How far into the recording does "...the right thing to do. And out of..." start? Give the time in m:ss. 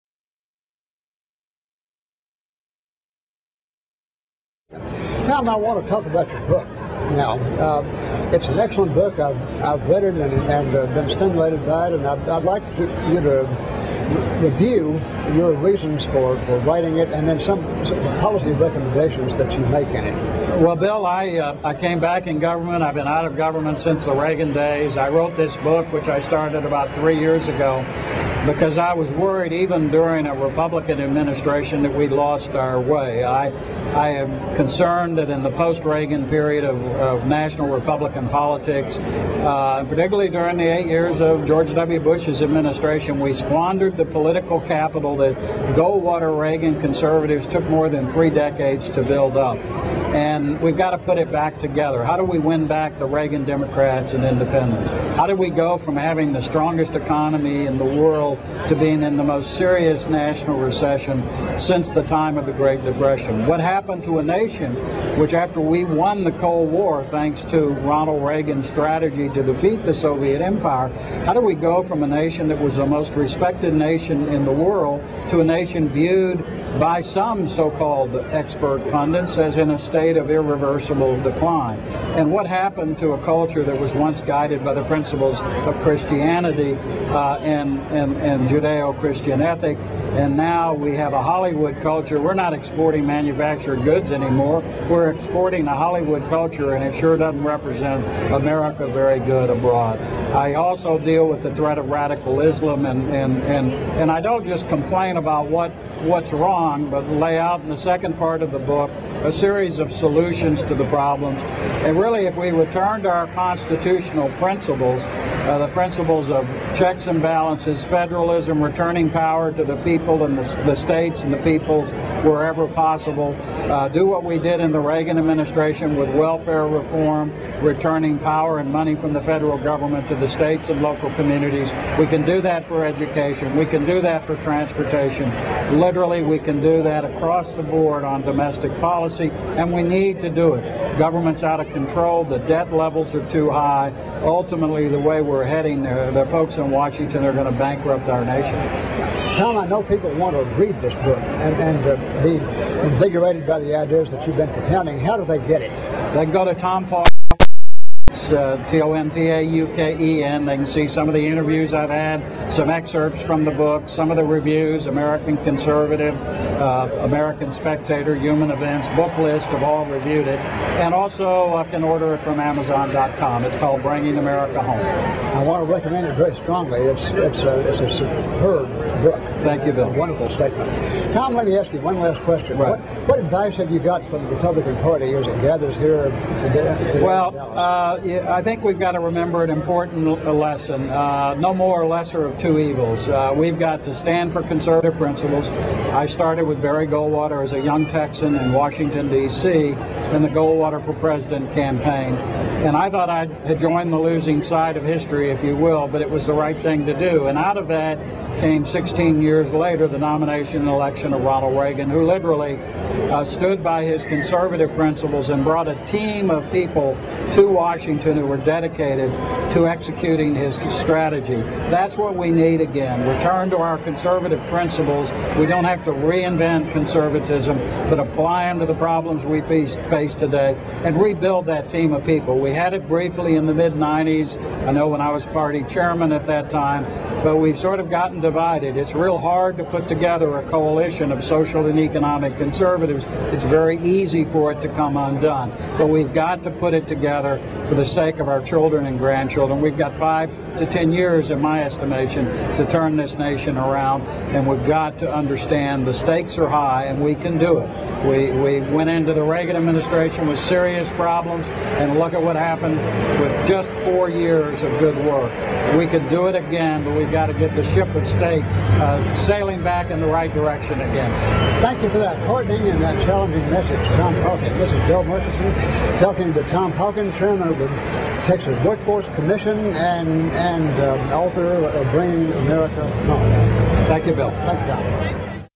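3:26.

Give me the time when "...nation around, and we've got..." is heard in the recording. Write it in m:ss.
4:13.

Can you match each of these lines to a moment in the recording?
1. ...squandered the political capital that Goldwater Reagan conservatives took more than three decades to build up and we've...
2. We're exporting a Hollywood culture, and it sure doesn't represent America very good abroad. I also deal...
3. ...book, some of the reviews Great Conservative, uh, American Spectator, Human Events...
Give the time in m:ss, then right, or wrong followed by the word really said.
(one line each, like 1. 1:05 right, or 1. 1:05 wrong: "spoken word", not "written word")
1. 0:43 right
2. 1:34 right
3. 2:43 wrong: "American", not "Great".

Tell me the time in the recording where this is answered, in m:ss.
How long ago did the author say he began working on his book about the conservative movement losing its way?
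0:26.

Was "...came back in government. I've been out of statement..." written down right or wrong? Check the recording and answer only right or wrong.
wrong.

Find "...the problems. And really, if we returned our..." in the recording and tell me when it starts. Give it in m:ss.
1:50.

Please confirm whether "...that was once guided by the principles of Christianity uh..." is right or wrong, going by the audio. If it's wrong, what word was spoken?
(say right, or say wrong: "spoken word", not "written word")
right.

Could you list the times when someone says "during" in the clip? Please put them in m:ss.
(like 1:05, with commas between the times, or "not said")
0:29, 0:40.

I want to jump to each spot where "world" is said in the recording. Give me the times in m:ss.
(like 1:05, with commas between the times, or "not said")
0:57, 1:14.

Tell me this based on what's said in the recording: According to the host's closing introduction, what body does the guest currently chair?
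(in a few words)
Texas Workforce Commission.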